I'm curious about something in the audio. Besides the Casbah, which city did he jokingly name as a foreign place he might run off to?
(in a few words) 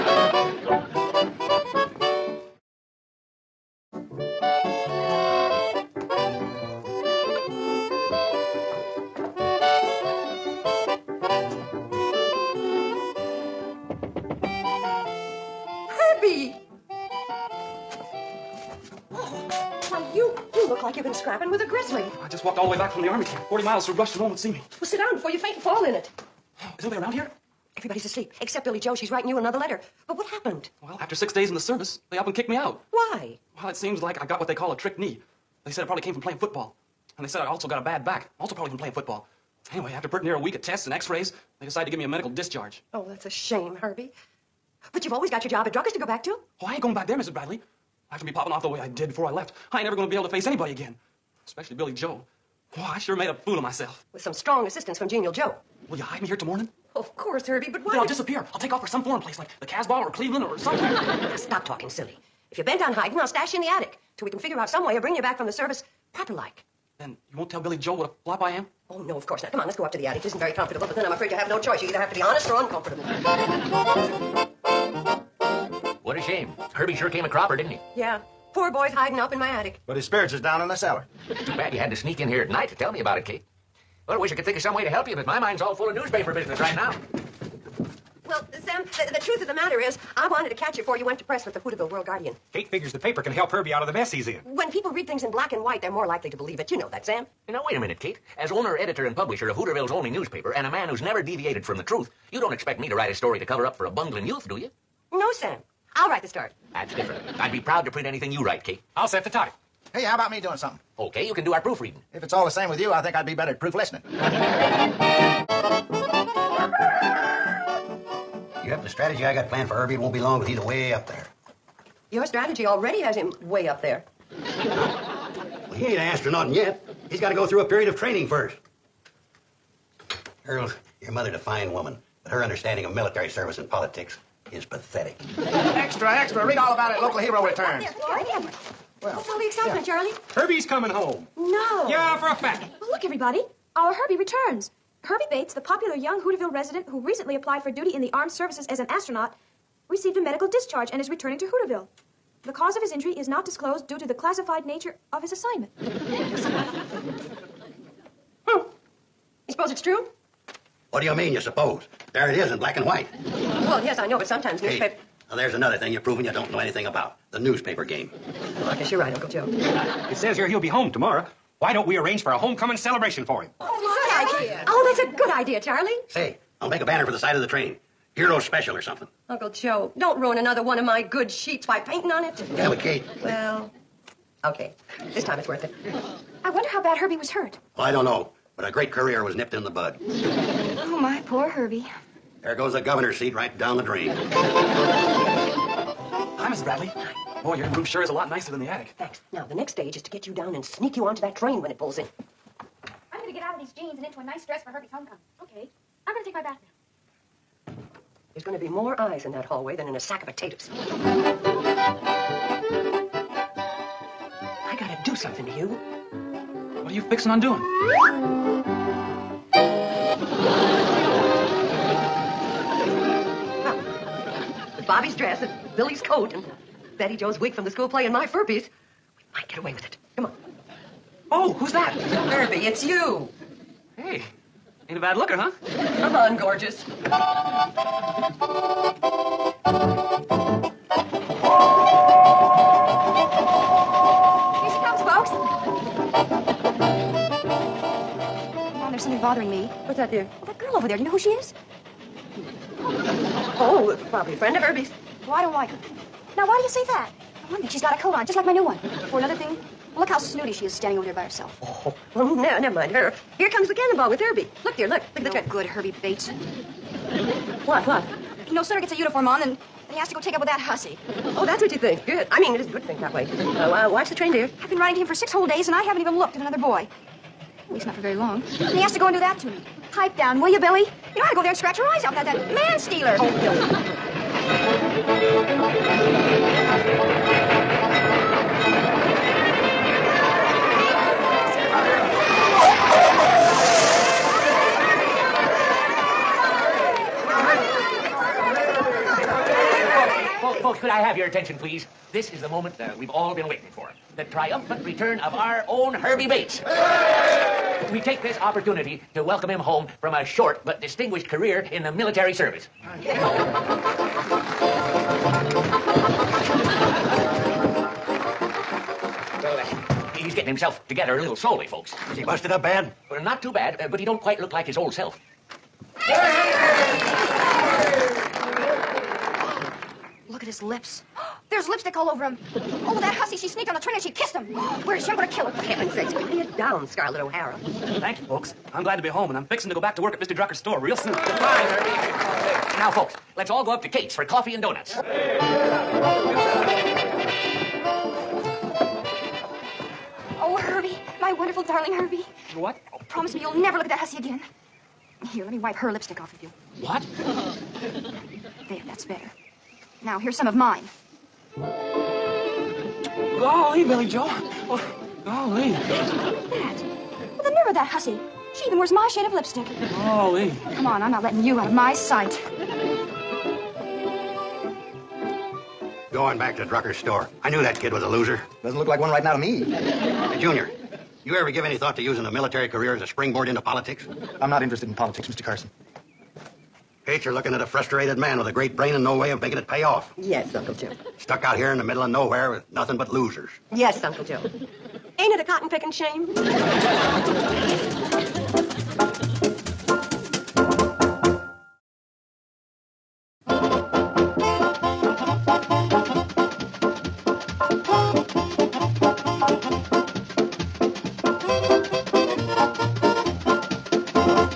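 Cleveland.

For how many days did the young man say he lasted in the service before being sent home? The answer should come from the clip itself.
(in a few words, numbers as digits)
6.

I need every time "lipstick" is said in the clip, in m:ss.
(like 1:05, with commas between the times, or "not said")
5:31, 5:55, 6:09.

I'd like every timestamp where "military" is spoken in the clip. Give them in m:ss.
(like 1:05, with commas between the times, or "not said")
2:12, 5:11, 6:22.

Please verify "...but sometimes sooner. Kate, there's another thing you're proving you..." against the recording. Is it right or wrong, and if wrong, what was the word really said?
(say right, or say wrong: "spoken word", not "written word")
wrong: "newspaper", not "sooner".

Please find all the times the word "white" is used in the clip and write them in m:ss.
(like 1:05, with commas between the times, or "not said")
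1:35, 2:42.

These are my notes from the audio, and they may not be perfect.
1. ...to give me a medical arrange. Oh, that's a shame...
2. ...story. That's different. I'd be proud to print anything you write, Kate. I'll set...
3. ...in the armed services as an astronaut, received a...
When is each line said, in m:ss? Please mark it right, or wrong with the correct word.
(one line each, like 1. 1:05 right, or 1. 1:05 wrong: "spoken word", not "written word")
1. 0:41 wrong: "discharge", not "arrange"
2. 1:46 right
3. 2:27 right.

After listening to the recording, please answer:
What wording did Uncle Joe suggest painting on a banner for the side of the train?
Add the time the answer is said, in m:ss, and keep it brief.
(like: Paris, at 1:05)
Hero special, at 2:58.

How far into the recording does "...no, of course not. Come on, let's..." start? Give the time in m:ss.
1:09.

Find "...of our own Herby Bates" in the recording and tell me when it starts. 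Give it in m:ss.
5:05.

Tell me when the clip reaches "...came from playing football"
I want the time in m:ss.
0:36.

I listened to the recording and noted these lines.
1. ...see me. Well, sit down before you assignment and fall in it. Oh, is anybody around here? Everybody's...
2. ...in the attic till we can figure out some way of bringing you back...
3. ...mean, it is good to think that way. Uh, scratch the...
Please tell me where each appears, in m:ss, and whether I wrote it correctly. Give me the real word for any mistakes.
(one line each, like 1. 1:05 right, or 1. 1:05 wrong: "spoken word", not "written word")
1. 0:24 wrong: "faint", not "assignment"
2. 1:03 right
3. 4:32 wrong: "watch", not "scratch".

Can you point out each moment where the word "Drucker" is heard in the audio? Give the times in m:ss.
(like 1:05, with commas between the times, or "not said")
0:45, 5:40, 6:16.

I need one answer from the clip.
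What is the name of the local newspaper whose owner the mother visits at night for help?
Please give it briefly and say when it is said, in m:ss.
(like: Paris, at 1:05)
Hooterville World Guardian, at 1:31.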